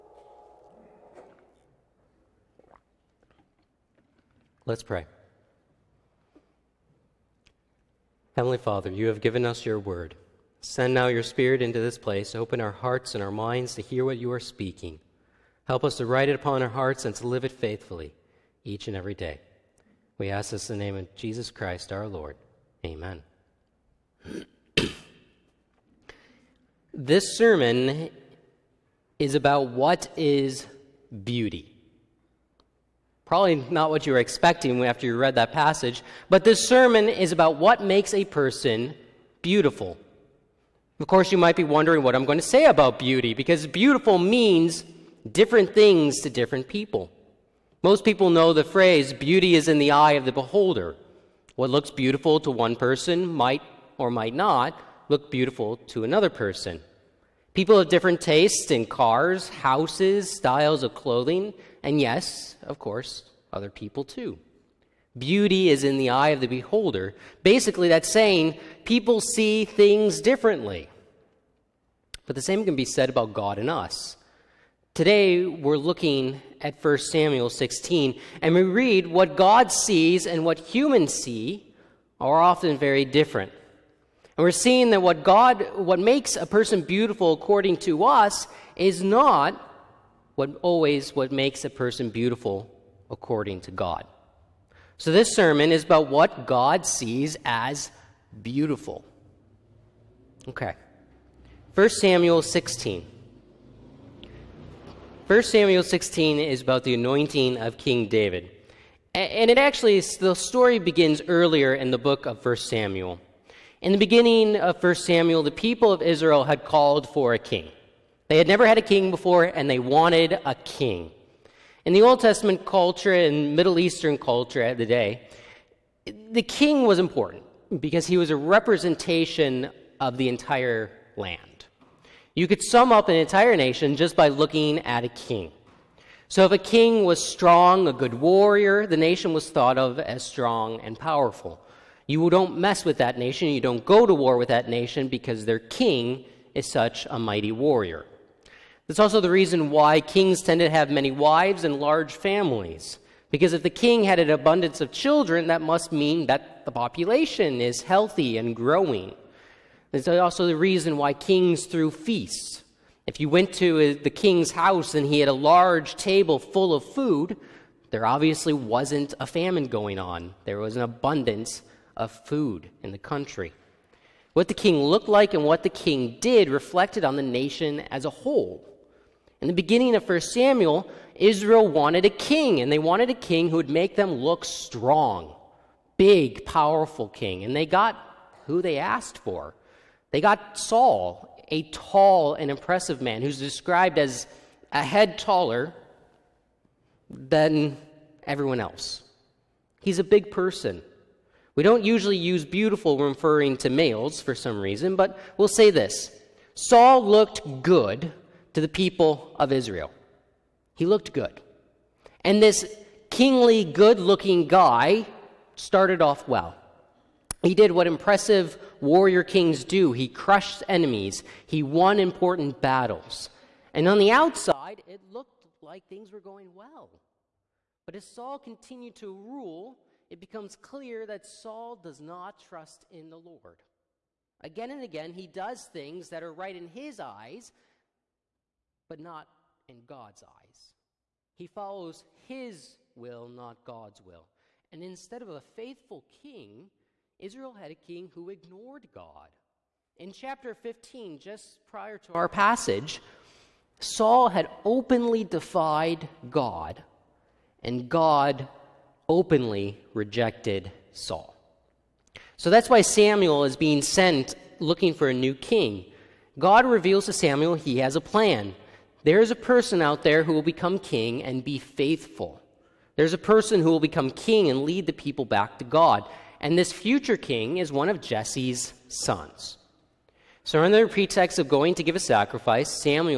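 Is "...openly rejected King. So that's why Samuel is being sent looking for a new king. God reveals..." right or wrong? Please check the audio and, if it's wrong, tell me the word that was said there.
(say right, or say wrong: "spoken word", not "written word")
wrong: "Saul", not "King".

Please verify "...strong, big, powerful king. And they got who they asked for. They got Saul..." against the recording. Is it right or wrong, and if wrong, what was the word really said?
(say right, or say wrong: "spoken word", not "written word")
right.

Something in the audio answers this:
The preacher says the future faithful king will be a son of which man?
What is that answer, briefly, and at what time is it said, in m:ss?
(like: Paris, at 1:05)
Jesse, at 4:37.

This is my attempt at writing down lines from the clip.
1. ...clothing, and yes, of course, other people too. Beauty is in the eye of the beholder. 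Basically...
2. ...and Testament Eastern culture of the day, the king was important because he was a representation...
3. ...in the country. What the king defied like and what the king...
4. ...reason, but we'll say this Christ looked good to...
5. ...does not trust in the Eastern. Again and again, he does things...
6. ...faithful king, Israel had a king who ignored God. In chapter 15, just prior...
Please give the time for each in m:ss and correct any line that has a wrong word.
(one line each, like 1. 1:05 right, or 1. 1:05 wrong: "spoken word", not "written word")
1. 1:00 right
2. 2:03 wrong: "Middle", not "Testament"
3. 2:52 wrong: "looked", not "defied"
4. 3:24 wrong: "Saul", not "Christ"
5. 3:51 wrong: "Lord", not "Eastern"
6. 4:05 right.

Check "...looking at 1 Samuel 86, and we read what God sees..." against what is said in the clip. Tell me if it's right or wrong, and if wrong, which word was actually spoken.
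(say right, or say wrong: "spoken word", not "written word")
wrong: "16", not "86".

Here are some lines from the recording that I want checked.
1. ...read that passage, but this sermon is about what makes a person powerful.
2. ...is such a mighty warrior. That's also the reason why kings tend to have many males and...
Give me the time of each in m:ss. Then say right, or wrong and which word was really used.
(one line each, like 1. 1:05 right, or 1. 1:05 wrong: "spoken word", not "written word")
1. 0:35 wrong: "beautiful", not "powerful"
2. 2:26 wrong: "wives", not "males".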